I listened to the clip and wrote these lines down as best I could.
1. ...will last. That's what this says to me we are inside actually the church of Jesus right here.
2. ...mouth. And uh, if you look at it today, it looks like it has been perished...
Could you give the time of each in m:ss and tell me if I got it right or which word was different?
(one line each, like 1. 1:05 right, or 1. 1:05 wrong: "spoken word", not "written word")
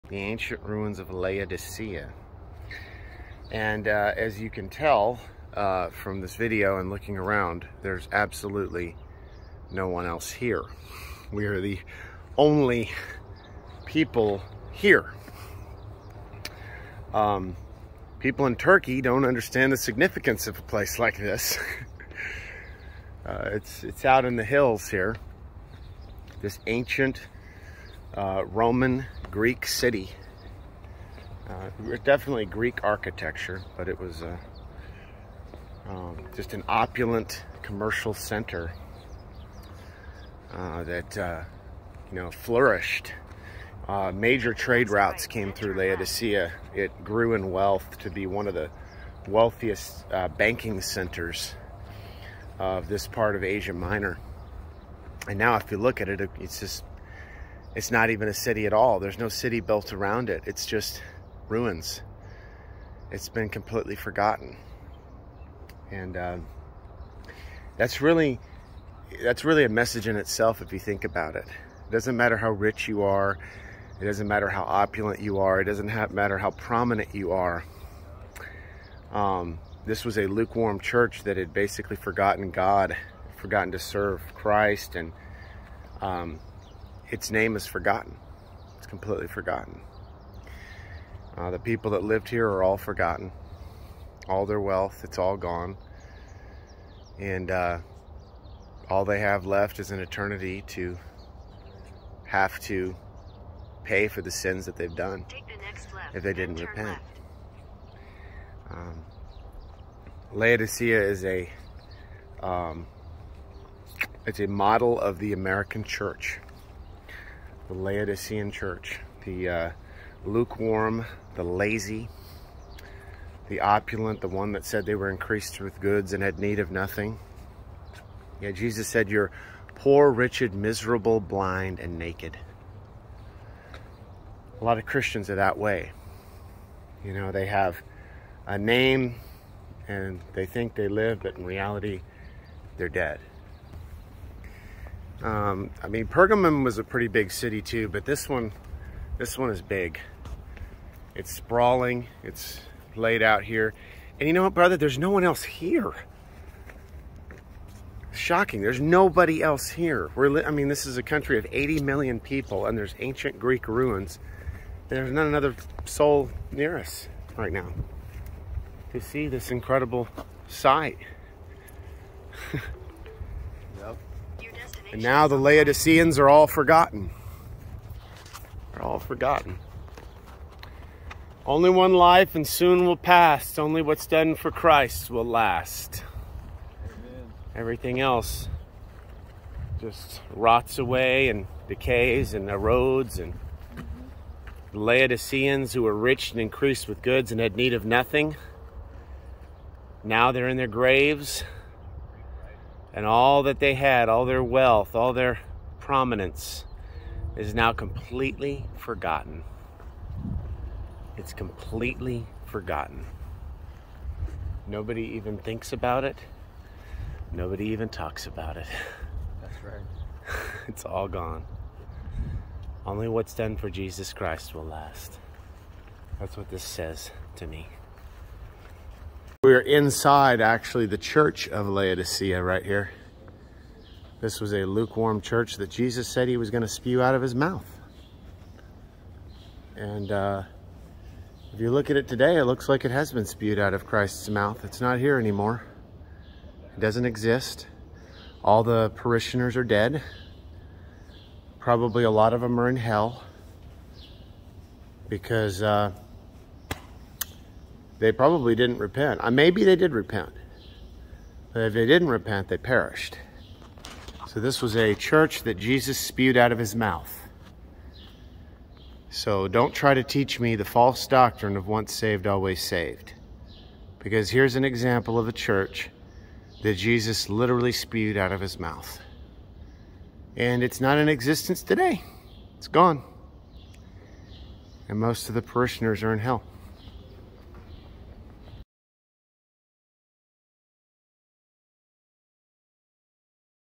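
1. 3:44 wrong: "Laodicea", not "Jesus"
2. 3:57 wrong: "spewed", not "perished".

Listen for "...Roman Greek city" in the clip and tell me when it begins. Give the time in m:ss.
0:28.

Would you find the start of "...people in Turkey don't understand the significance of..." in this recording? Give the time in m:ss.
0:18.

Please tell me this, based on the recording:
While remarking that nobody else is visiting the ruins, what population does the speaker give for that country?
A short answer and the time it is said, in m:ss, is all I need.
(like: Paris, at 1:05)
80 million, at 2:41.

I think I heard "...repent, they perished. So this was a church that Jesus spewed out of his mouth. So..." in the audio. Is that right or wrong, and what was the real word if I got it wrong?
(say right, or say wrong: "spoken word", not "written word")
right.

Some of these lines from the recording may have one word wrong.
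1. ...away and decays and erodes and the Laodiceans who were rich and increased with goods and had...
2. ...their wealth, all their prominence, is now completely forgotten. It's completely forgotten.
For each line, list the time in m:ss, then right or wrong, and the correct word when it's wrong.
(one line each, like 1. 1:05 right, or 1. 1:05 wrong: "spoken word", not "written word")
1. 3:10 right
2. 3:24 right.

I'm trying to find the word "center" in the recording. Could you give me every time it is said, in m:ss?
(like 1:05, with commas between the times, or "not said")
0:38, 0:50.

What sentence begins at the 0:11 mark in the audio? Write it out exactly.
We are the only people here.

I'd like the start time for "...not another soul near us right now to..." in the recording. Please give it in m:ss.
2:45.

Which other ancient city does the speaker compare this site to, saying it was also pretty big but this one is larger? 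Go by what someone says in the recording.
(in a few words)
Pergamum.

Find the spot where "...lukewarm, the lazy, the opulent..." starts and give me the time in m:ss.
2:00.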